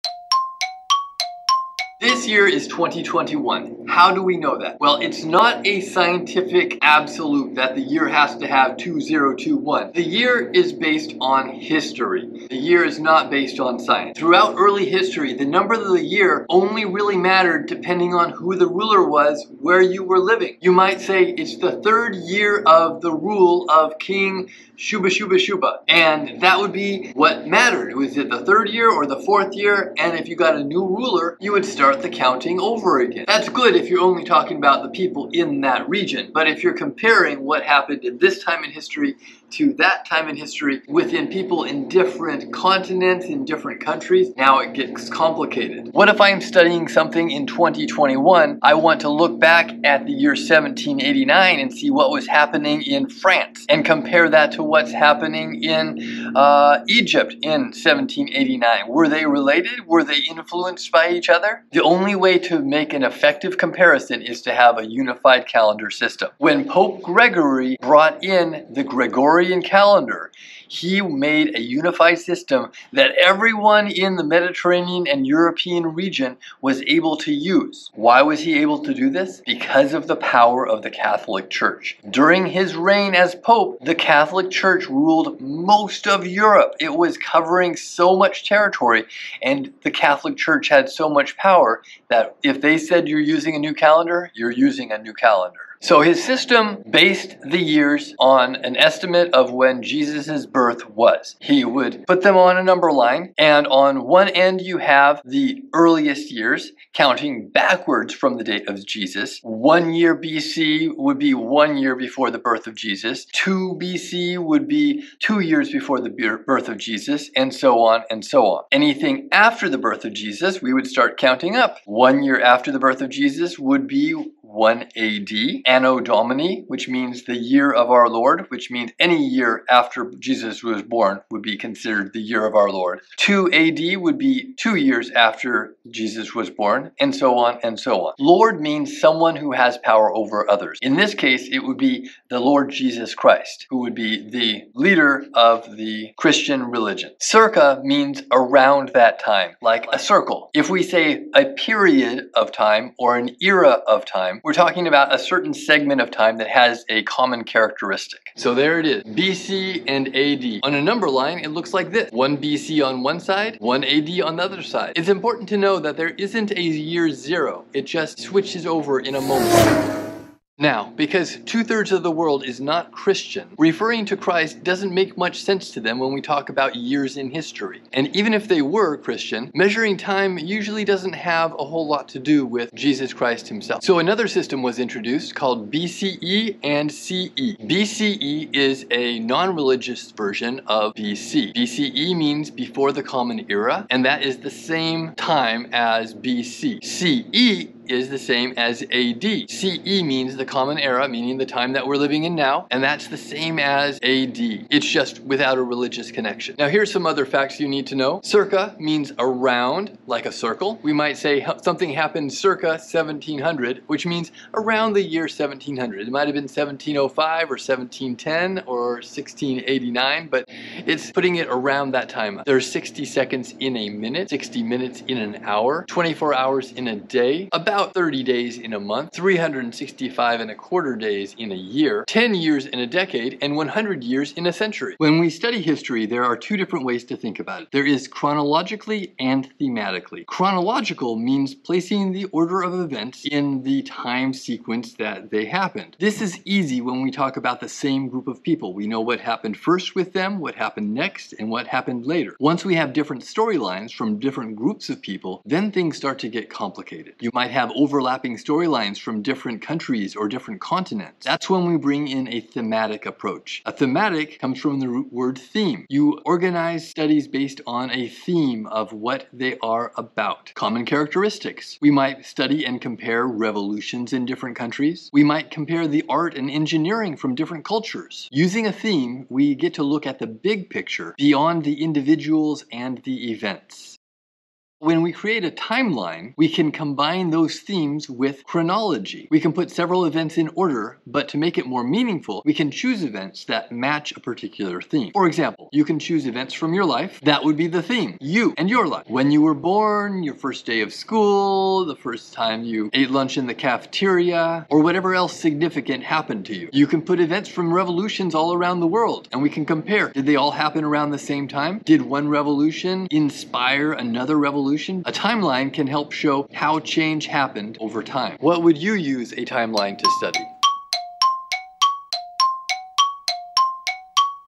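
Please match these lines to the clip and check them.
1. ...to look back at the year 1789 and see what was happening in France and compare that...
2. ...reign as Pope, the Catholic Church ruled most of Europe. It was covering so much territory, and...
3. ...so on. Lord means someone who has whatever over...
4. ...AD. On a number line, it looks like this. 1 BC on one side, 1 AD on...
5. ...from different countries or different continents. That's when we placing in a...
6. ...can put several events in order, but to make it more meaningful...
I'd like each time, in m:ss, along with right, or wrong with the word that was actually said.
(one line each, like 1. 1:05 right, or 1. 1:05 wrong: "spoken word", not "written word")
1. 0:49 right
2. 1:22 right
3. 2:17 wrong: "power", not "whatever"
4. 2:40 right
5. 4:18 wrong: "bring", not "placing"
6. 4:49 right.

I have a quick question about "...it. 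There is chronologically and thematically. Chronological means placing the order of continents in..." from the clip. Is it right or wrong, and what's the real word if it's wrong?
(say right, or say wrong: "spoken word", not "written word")
wrong: "events", not "continents".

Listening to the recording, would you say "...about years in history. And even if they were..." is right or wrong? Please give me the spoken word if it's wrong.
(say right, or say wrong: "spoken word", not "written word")
right.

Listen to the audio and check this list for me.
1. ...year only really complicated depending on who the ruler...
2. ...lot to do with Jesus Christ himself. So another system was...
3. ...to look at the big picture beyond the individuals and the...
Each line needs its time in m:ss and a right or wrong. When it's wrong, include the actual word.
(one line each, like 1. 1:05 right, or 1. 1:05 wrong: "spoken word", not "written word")
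1. 0:16 wrong: "mattered", not "complicated"
2. 3:01 right
3. 4:39 right.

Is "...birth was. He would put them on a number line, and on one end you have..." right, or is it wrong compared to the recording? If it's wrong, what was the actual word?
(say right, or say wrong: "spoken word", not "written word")
right.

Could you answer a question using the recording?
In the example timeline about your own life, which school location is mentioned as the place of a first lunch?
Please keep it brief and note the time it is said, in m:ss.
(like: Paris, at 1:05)
cafeteria, at 5:03.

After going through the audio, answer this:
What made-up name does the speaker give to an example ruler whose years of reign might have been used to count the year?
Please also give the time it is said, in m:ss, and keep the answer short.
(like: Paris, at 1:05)
King Shuba Shuba Shuba, at 0:23.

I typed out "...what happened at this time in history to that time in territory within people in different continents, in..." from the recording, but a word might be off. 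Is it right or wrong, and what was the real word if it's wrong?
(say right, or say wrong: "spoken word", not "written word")
wrong: "history", not "territory".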